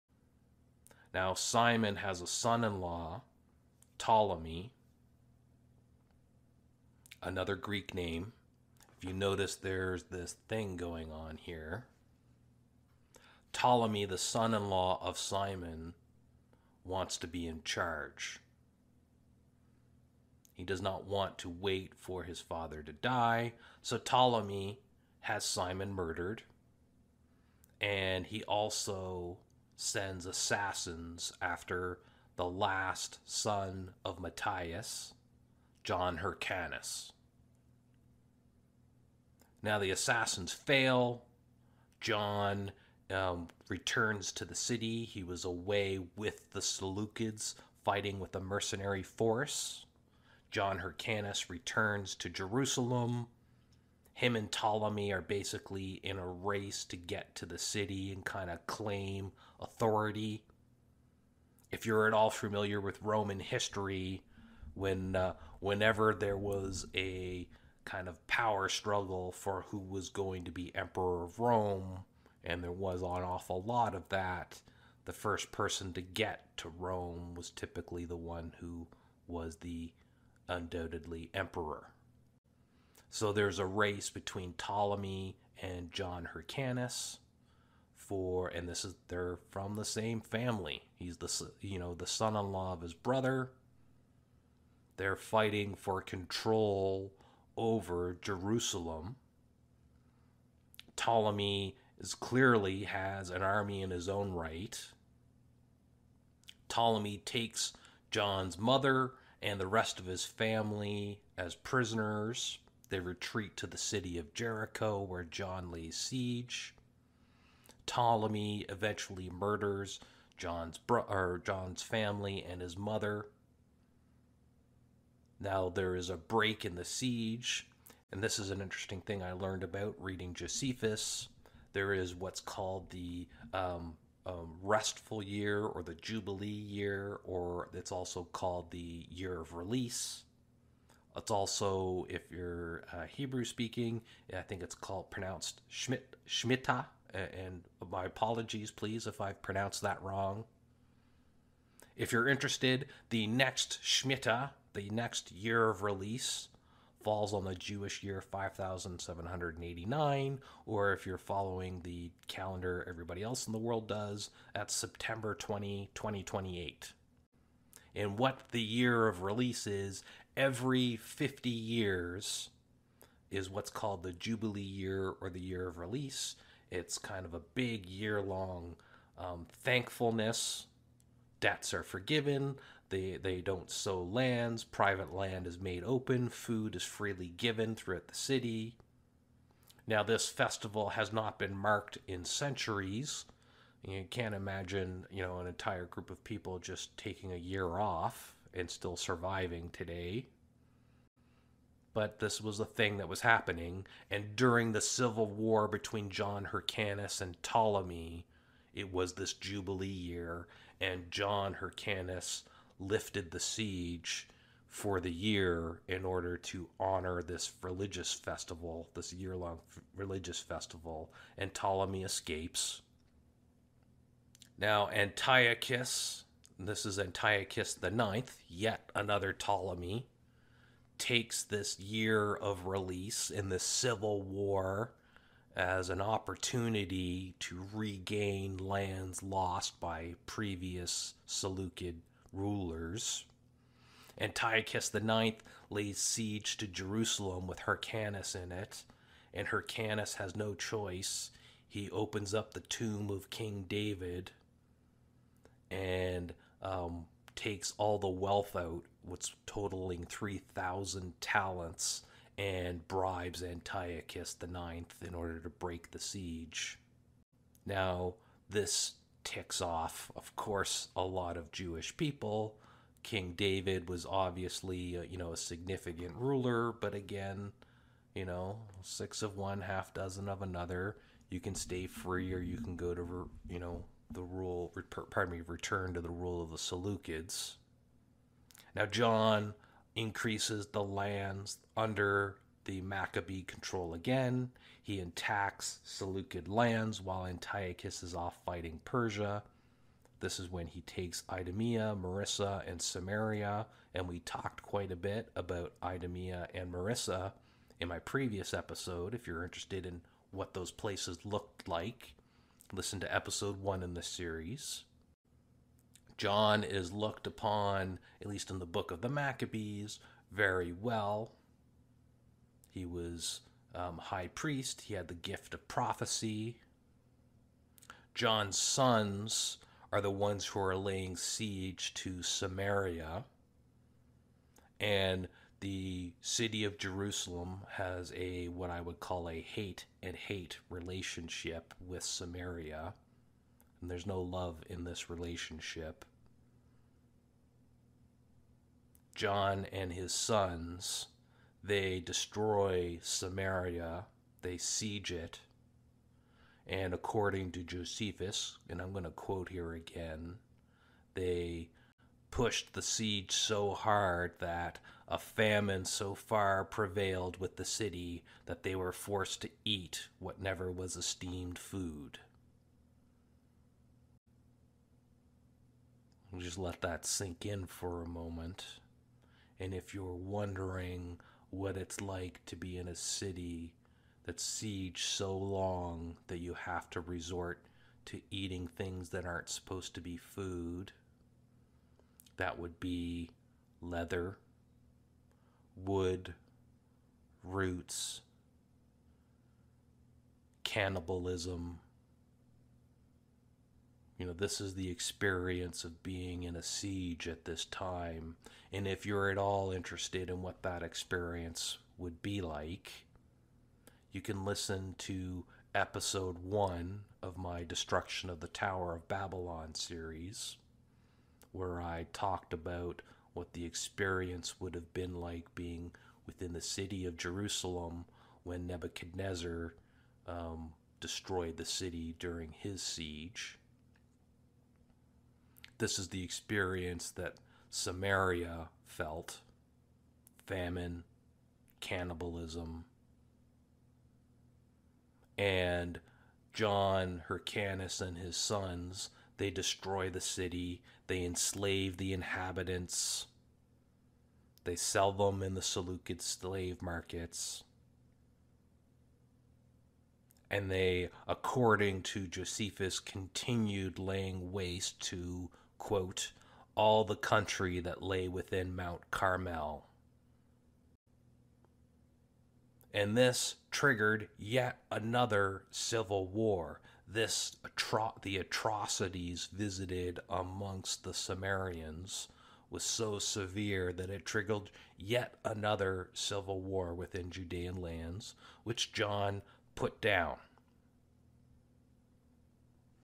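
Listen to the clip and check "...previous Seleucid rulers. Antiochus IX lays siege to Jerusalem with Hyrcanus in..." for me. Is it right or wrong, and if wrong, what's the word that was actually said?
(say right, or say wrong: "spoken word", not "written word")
right.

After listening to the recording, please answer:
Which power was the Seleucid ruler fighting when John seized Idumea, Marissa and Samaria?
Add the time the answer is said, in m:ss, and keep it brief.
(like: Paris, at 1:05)
Persia, at 4:58.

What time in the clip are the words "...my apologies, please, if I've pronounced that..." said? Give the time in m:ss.
2:27.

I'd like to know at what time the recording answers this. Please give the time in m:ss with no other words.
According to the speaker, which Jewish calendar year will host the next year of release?
2:38.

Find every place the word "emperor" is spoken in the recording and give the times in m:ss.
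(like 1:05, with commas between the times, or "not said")
1:10, 1:21.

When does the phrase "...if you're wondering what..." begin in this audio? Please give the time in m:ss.
6:19.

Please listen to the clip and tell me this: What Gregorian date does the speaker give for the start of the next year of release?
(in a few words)
September 20, 2028.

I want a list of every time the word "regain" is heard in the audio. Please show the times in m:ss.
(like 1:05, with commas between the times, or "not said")
3:57.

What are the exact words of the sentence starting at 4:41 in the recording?
You can stay free or you can go to, you know, the rule, pardon me, return to the rule of the Seleucids.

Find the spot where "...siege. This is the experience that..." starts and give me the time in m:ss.
7:12.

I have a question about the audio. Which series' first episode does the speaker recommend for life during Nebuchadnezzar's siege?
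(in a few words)
Destruction of the Tower of Babylon.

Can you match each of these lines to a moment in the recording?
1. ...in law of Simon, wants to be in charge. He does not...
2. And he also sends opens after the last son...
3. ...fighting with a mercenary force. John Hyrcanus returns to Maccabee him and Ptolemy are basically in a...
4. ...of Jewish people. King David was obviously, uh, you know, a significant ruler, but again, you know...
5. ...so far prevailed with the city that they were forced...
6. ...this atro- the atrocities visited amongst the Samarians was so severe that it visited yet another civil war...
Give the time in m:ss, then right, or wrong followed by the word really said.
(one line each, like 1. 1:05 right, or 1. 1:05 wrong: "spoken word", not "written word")
1. 0:14 right
2. 0:27 wrong: "assassins", not "opens"
3. 0:47 wrong: "Jerusalem", not "Maccabee"
4. 4:31 right
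5. 6:05 right
6. 7:57 wrong: "triggered", not "visited".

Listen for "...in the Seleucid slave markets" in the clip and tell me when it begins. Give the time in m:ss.
7:35.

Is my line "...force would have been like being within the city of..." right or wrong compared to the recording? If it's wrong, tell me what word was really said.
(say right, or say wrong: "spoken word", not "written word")
wrong: "experience", not "force".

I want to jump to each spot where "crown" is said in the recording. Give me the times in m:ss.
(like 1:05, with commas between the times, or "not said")
not said.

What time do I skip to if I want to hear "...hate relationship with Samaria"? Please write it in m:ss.
5:40.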